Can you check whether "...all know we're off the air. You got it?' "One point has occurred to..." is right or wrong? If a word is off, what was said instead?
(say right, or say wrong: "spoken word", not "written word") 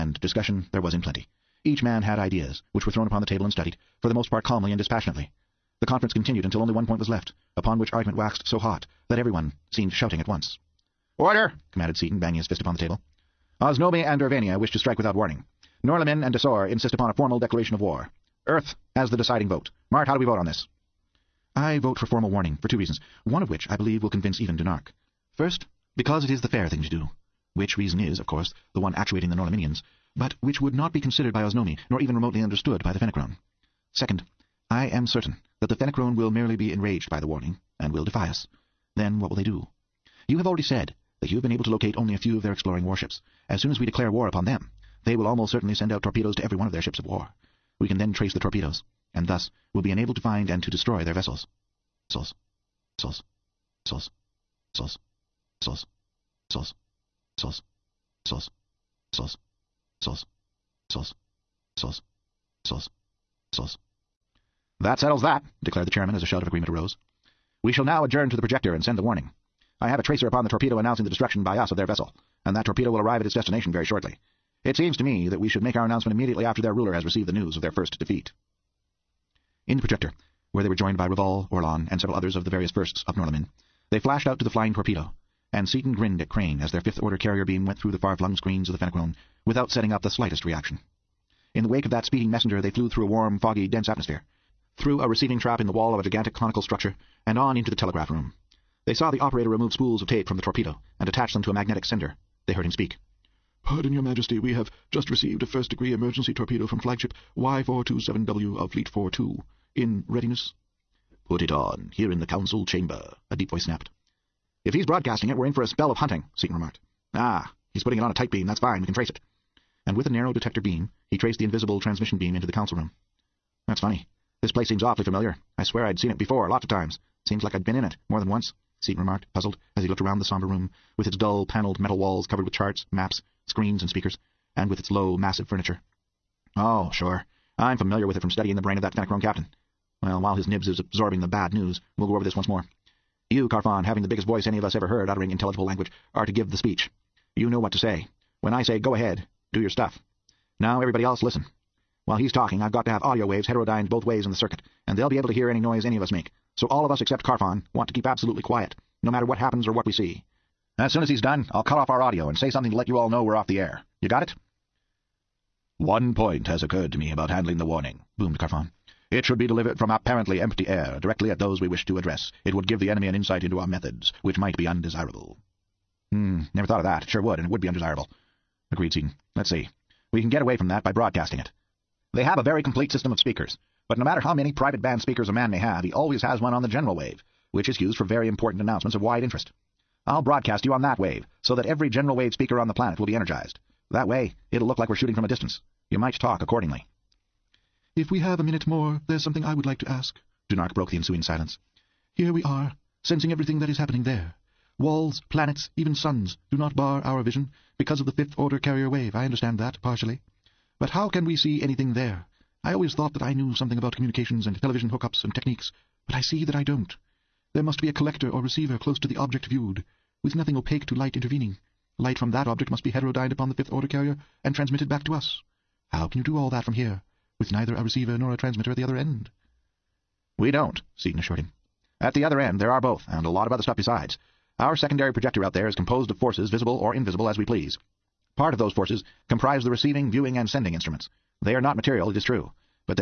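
right.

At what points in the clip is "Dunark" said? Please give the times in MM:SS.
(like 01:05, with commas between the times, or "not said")
00:24, 03:20.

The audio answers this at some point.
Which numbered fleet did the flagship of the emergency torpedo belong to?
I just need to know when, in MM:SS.
01:48.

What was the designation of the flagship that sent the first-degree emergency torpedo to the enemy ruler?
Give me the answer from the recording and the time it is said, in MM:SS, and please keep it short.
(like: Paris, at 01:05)
Y427W, at 01:47.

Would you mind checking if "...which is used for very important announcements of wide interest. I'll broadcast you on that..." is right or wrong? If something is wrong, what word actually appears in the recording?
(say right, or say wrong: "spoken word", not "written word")
right.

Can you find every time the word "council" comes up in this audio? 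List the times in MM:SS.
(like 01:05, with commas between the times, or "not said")
01:52, 02:02.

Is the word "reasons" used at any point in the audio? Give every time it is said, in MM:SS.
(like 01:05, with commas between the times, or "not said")
00:22, 00:27.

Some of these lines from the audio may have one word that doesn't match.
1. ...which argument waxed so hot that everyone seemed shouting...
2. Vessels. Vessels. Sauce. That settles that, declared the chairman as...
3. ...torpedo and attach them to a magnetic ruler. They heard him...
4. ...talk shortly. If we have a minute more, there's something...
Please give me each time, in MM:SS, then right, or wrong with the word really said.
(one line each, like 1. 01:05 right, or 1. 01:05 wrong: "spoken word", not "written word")
1. 00:07 right
2. 01:00 right
3. 01:40 wrong: "sender", not "ruler"
4. 03:16 wrong: "accordingly", not "shortly".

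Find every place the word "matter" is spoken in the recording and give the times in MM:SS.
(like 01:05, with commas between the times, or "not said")
02:39, 03:04.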